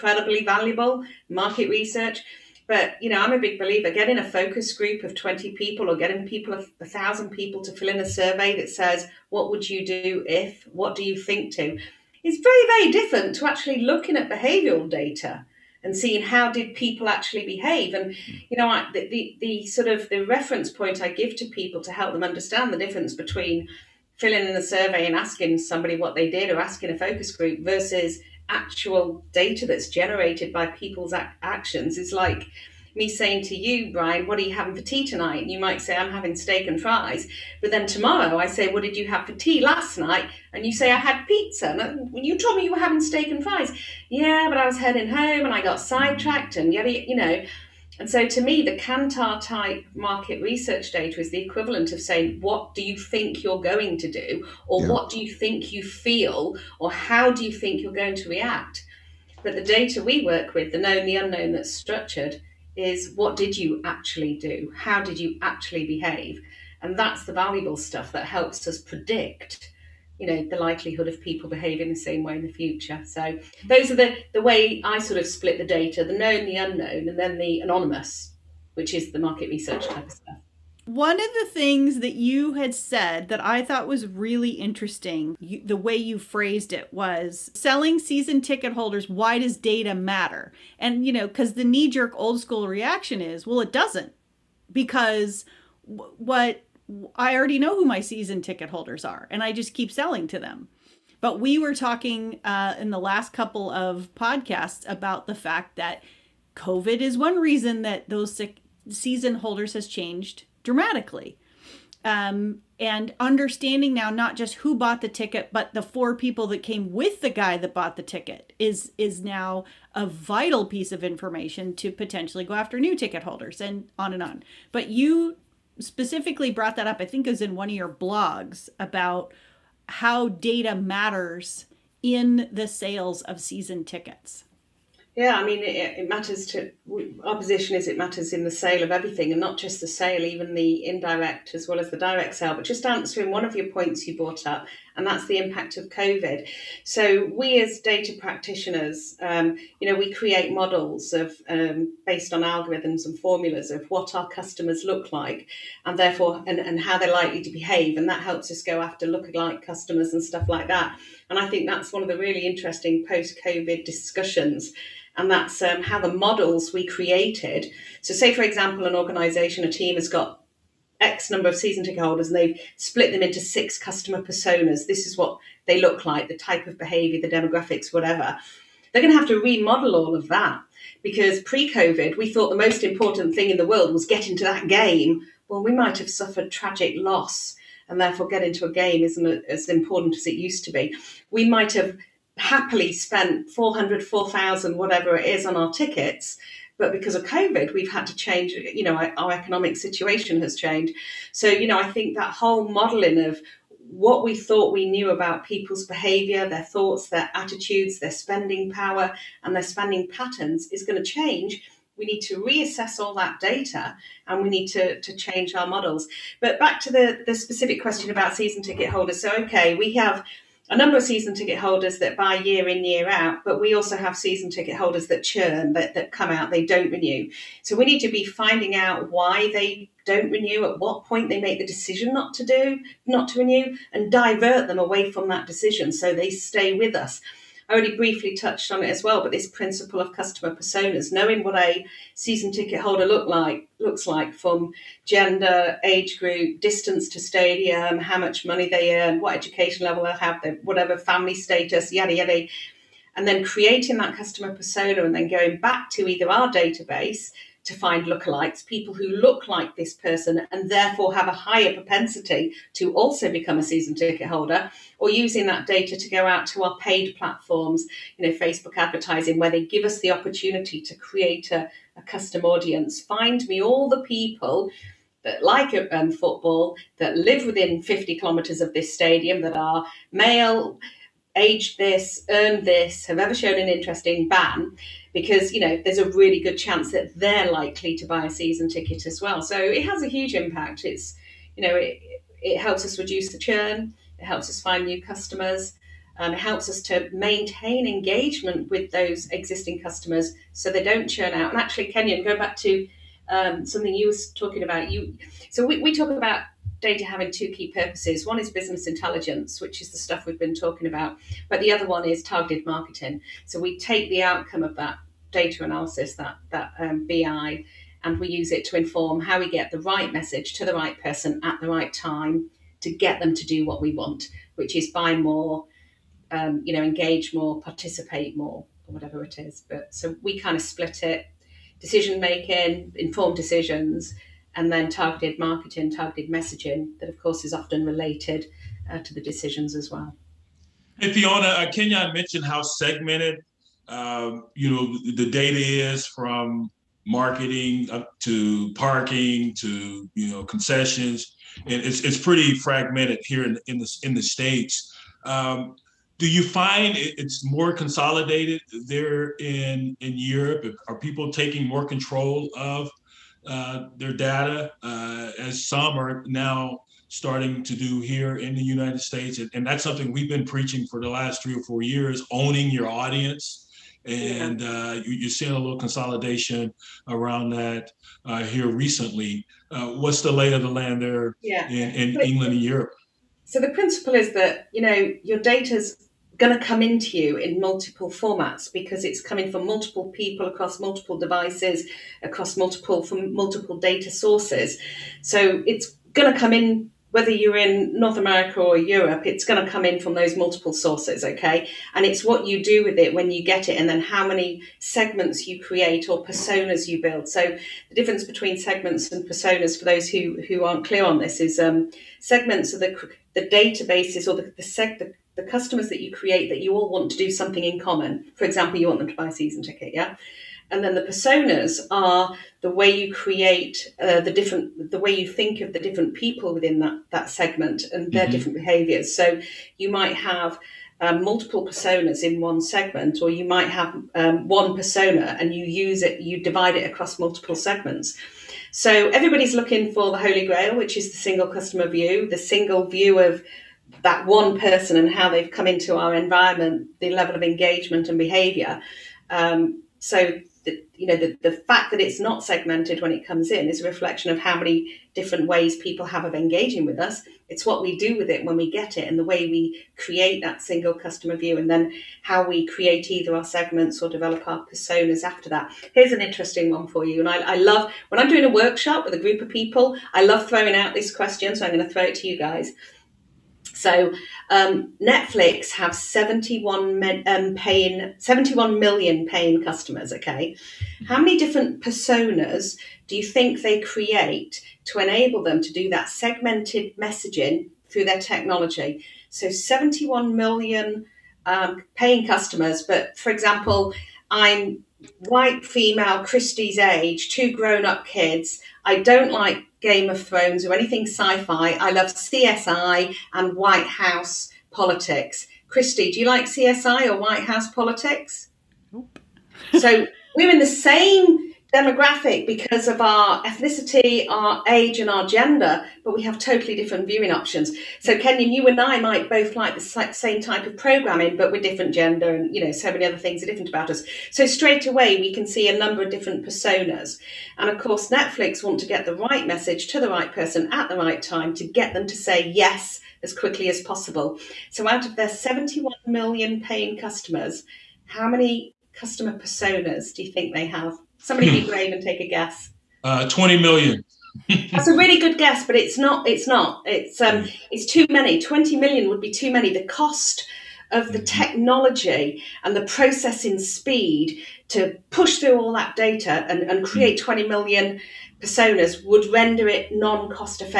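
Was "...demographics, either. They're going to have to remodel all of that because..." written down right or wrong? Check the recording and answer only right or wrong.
wrong.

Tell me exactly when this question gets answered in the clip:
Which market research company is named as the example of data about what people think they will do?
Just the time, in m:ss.
0:48.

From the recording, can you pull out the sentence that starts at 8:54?
So, out of their 71 million paying customers, how many customer personas do you think they have?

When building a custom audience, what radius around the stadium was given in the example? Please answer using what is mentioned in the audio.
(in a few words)
50 kilometres.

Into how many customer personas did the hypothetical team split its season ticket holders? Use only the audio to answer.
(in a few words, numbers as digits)
6.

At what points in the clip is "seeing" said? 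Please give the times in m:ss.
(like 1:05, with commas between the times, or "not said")
0:15, 6:15.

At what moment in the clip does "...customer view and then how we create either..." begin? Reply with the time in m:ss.
7:40.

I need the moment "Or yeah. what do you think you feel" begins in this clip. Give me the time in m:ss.
0:54.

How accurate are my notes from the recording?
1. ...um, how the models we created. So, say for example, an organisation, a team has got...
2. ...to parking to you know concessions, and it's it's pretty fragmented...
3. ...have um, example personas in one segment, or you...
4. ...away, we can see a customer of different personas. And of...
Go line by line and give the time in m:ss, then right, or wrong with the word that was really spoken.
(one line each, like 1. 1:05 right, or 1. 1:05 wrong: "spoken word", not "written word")
1. 2:45 right
2. 5:48 right
3. 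7:10 wrong: "multiple", not "example"
4. 8:44 wrong: "number", not "customer".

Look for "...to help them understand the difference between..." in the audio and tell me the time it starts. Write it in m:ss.
0:21.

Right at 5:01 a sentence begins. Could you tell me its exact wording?
And actually, Kenyon, go back to um, something you was talking about.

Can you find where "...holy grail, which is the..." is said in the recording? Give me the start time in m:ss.
7:20.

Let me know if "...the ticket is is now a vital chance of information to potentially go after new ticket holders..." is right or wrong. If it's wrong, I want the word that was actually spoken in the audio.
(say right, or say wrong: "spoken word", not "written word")
wrong: "piece", not "chance".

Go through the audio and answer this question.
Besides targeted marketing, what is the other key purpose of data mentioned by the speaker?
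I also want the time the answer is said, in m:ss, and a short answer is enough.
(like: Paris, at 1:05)
Business intelligence, at 5:08.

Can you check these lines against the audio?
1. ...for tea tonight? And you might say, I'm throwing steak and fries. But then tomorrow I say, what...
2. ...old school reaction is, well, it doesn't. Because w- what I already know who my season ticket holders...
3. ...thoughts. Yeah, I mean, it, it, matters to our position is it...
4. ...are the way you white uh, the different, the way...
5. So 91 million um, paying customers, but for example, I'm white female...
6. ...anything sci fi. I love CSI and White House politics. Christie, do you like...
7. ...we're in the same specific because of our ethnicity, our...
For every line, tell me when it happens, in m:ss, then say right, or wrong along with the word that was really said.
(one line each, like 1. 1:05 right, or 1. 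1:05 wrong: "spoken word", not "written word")
1. 0:34 wrong: "having", not "throwing"
2. 1:32 right
3. 2:13 wrong: "tickets", not "thoughts"
4. 7:01 wrong: "create", not "white"
5. 8:09 wrong: "71", not "91"
6. 8:20 right
7. 8:30 wrong: "demographic", not "specific".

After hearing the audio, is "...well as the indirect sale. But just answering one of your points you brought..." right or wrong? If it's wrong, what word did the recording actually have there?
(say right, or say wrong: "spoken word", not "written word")
wrong: "direct", not "indirect".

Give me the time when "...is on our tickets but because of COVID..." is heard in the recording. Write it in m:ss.
3:15.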